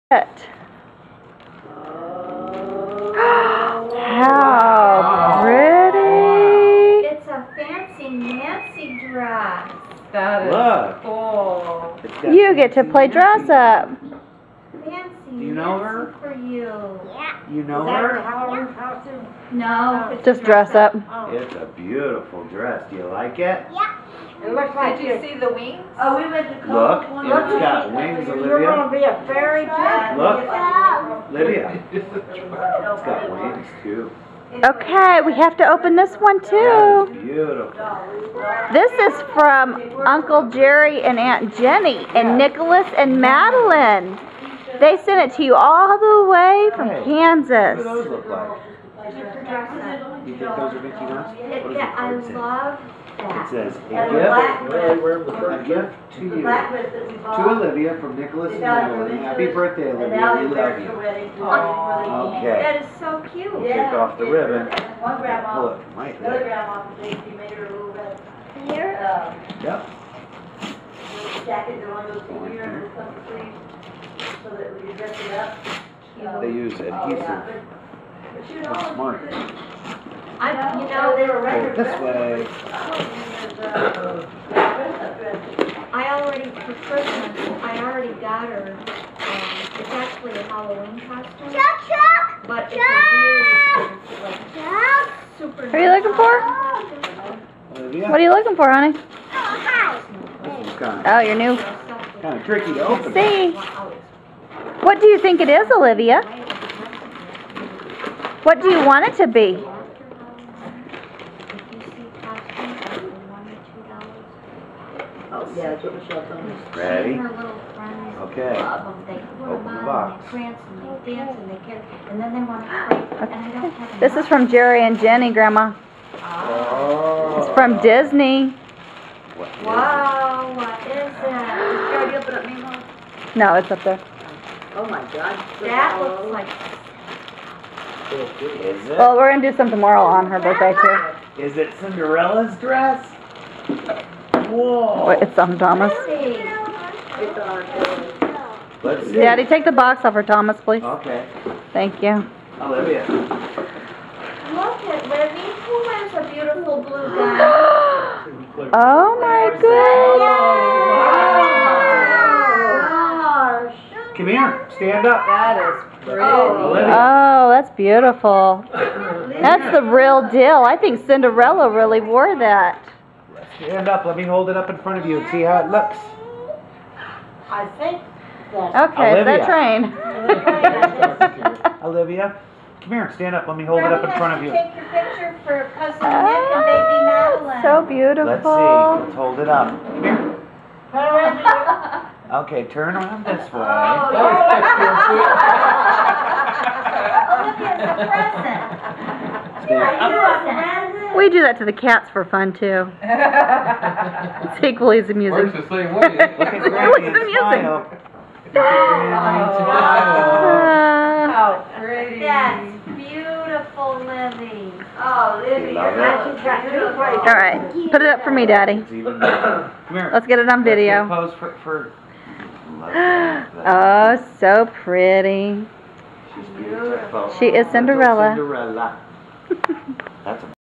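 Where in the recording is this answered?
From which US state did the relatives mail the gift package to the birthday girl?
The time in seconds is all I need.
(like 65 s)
47 s.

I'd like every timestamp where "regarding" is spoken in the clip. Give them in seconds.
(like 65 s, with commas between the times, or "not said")
not said.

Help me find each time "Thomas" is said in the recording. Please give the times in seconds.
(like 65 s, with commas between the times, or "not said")
145 s, 150 s.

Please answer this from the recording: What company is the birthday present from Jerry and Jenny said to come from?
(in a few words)
Disney.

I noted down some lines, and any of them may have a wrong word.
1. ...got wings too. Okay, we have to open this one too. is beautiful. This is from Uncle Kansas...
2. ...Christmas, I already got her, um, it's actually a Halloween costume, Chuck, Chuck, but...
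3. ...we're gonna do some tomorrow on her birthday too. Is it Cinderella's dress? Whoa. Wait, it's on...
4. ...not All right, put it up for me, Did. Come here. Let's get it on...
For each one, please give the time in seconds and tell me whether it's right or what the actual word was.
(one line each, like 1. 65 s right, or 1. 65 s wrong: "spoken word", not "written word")
1. 33 s wrong: "Jerry", not "Kansas"
2. 86 s right
3. 139 s right
4. 215 s wrong: "Daddy", not "Did".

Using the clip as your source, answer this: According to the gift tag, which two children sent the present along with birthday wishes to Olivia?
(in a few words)
Nicholas and Emily.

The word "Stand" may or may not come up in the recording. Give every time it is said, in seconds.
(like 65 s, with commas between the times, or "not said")
164 s, 173 s, 183 s.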